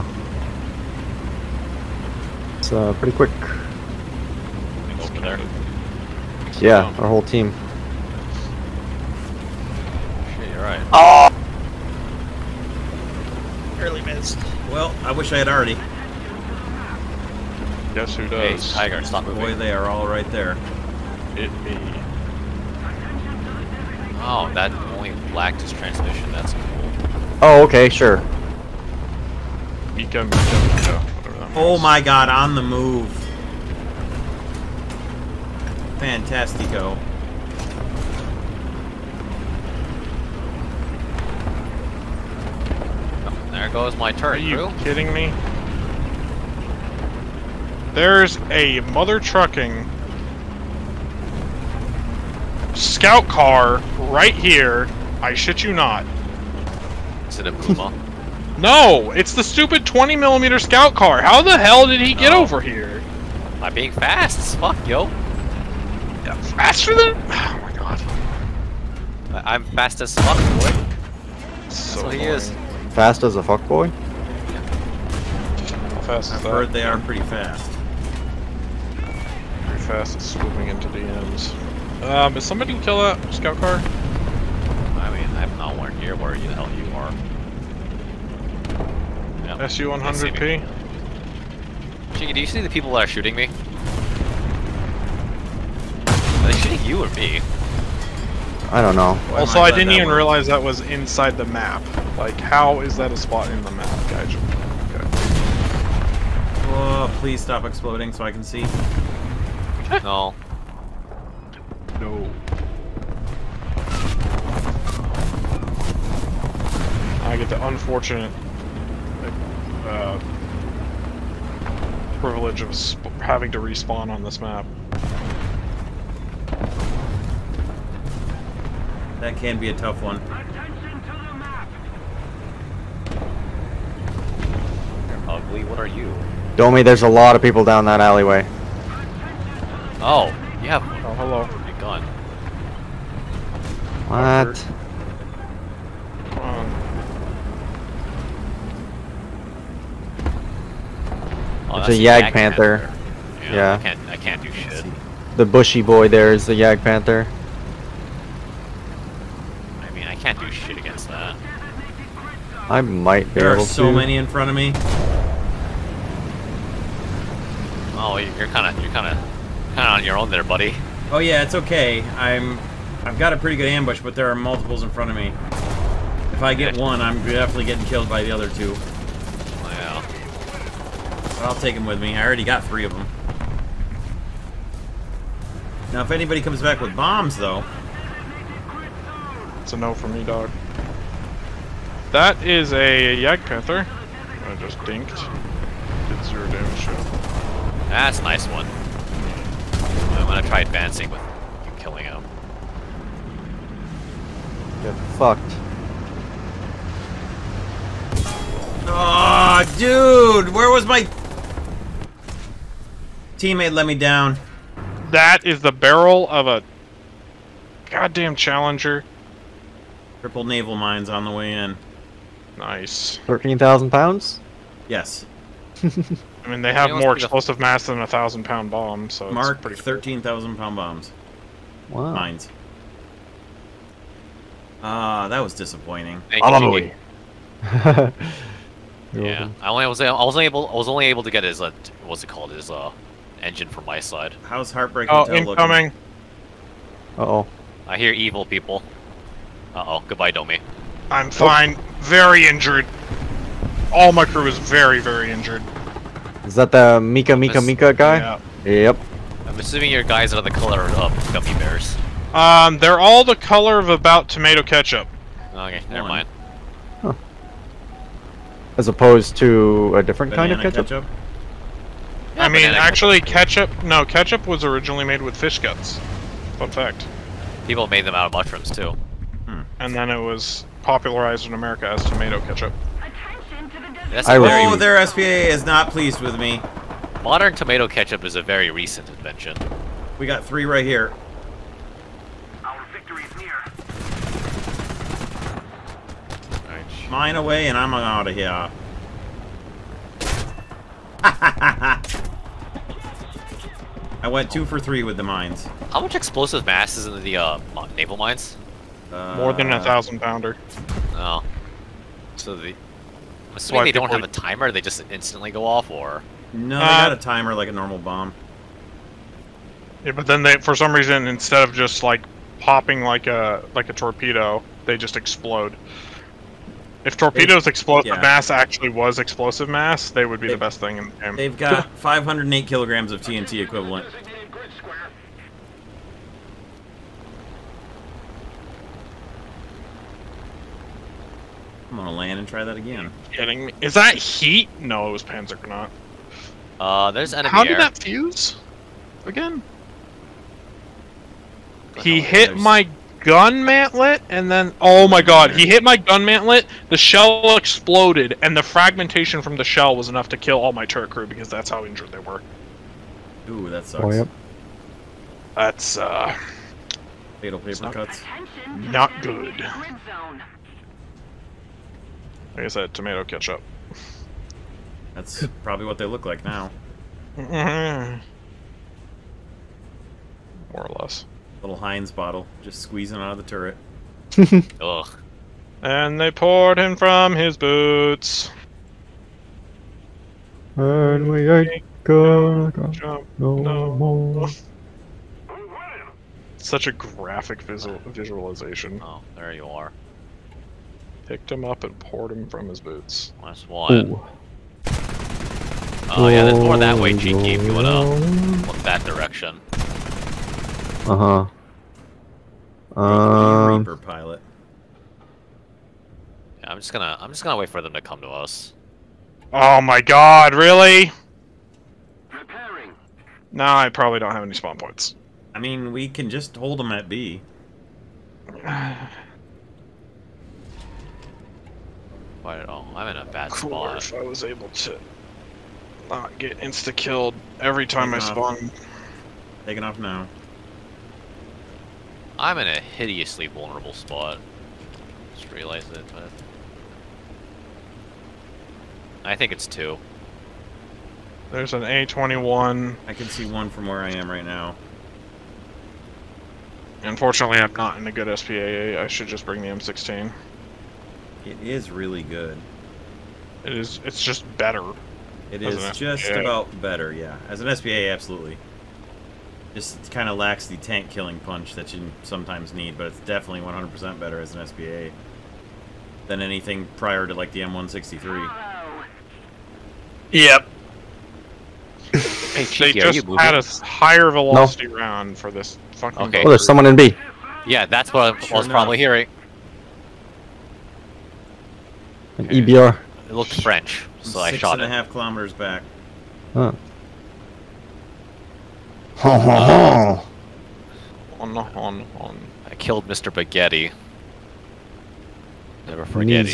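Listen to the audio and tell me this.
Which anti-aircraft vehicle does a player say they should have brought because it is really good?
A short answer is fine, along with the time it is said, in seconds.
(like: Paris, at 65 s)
M16, at 459 s.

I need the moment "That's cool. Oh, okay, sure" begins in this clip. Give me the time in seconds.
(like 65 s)
26 s.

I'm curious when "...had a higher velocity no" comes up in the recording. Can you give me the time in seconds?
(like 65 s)
483 s.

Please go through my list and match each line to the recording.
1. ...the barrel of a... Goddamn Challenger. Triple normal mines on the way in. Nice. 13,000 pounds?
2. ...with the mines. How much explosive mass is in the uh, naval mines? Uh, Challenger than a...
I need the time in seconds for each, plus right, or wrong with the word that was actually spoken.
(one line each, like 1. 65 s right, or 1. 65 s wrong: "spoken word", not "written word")
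1. 215 s wrong: "naval", not "normal"
2. 305 s wrong: "More", not "Challenger".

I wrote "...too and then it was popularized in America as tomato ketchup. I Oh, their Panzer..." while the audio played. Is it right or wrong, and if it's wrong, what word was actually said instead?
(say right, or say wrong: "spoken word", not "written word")
wrong: "SPA", not "Panzer".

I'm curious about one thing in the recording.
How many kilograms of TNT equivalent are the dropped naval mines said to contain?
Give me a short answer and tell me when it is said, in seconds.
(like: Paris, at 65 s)
508, at 331 s.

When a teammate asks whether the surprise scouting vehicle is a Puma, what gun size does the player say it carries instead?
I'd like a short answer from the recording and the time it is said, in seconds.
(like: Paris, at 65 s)
20 millimeter, at 59 s.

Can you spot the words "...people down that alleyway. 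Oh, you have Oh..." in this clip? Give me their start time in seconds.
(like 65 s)
137 s.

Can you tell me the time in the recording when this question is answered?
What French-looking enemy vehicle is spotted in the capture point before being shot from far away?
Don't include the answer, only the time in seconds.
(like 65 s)
492 s.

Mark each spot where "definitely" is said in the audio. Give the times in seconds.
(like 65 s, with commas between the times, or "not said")
177 s, 473 s.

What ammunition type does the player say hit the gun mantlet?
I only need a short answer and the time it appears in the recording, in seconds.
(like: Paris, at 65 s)
Panzer not, at 345 s.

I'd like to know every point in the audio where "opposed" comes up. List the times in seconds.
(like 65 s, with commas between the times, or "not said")
268 s.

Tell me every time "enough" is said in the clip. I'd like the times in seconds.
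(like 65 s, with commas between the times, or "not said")
360 s.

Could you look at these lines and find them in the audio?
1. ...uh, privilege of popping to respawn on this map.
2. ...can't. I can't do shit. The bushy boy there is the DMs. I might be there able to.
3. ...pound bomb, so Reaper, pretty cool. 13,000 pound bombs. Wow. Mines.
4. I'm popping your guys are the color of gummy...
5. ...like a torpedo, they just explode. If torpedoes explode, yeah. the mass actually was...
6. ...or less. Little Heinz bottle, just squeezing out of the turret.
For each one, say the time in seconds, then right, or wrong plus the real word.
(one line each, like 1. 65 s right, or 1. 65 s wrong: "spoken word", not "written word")
1. 119 s wrong: "having", not "popping"
2. 153 s wrong: "Jagdpanther", not "DMs"
3. 228 s wrong: "Mark", not "Reaper"
4. 259 s wrong: "assuming", not "popping"
5. 323 s right
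6. 380 s right.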